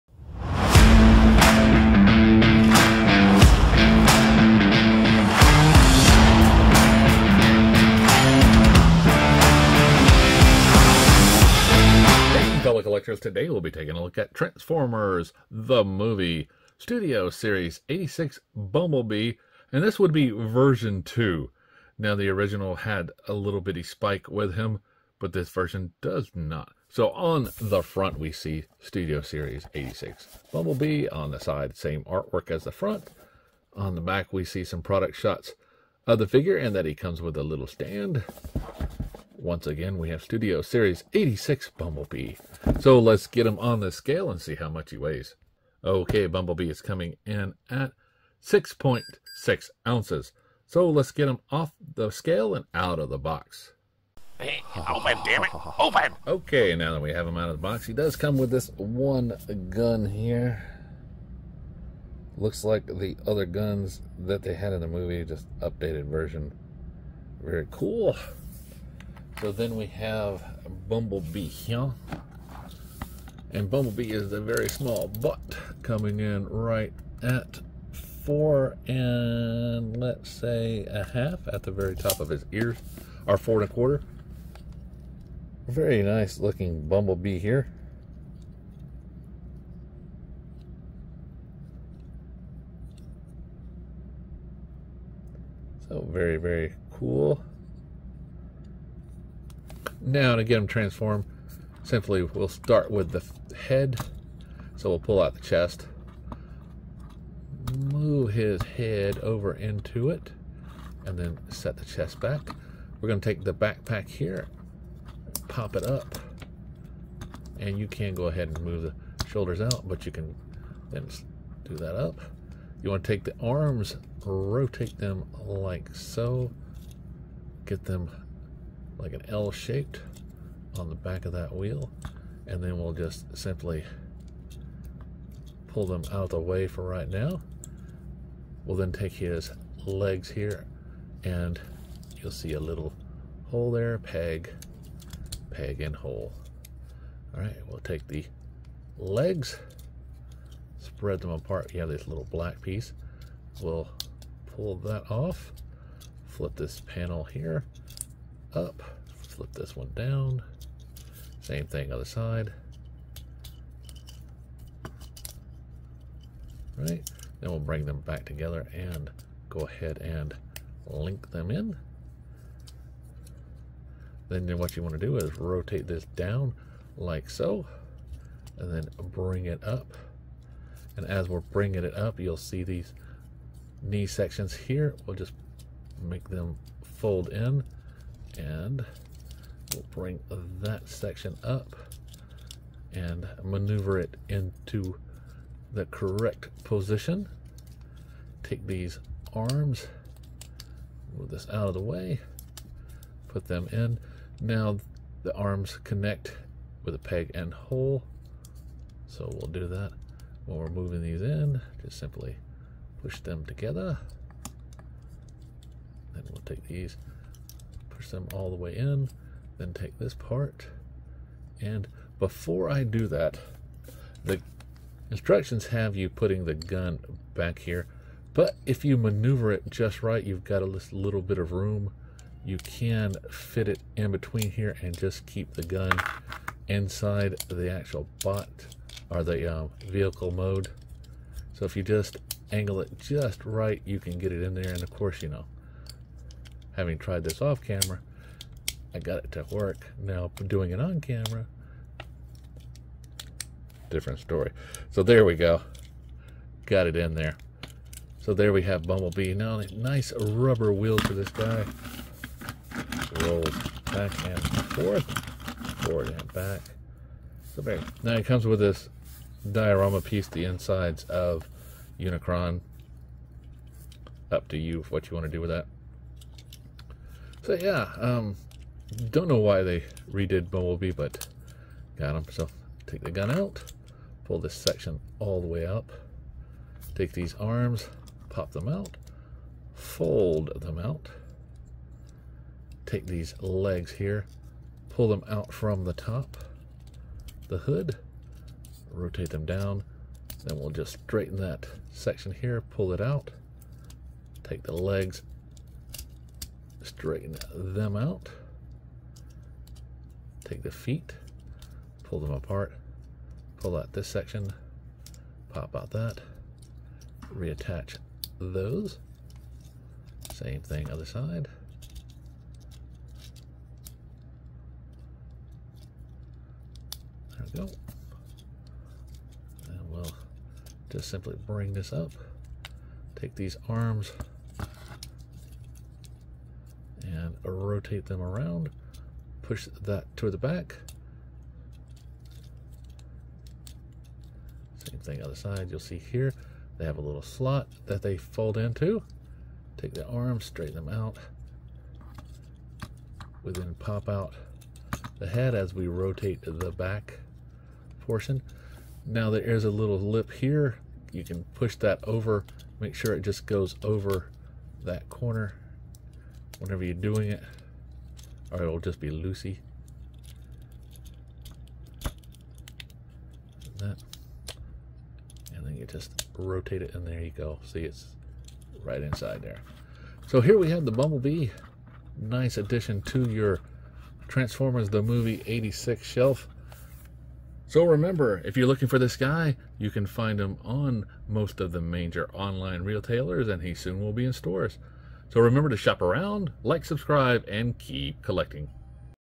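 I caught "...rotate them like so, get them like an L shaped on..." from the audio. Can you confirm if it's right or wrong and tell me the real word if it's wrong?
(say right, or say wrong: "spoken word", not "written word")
right.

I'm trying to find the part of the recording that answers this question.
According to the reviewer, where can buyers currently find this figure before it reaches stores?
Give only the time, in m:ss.
6:31.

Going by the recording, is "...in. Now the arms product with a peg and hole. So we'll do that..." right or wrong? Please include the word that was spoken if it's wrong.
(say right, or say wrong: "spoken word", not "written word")
wrong: "connect", not "product".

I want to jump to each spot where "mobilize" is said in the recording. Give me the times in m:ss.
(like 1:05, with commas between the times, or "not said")
not said.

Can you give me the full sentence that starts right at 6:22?
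Nice addition to your Transformers the Movie 86 shelf.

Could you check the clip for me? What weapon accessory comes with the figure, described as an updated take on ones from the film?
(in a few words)
one gun.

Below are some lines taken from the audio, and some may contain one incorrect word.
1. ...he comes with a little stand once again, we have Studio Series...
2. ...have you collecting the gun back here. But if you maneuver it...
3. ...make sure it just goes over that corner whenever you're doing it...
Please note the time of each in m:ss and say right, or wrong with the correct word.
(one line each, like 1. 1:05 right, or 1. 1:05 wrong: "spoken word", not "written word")
1. 0:36 right
2. 3:45 wrong: "putting", not "collecting"
3. 6:02 right.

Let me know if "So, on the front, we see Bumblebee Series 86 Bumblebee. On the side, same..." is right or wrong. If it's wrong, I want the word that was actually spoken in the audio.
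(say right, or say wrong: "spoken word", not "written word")
wrong: "Studio", not "Bumblebee".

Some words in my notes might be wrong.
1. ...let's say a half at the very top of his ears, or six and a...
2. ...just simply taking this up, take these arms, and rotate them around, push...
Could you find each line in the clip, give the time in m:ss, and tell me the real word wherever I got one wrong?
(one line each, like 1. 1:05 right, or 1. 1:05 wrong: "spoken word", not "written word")
1. 1:19 wrong: "four", not "six"
2. 5:30 wrong: "bring", not "taking".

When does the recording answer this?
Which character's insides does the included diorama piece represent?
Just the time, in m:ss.
4:31.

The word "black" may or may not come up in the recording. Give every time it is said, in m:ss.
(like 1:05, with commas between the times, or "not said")
2:32.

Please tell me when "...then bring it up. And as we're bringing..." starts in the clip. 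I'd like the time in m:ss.
2:58.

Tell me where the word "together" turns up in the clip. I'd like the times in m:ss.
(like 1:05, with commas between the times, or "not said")
2:48, 3:33.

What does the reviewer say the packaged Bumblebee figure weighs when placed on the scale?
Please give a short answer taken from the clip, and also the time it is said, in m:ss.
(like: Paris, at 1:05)
6.6 ounces, at 0:48.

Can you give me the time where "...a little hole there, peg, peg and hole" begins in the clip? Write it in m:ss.
2:22.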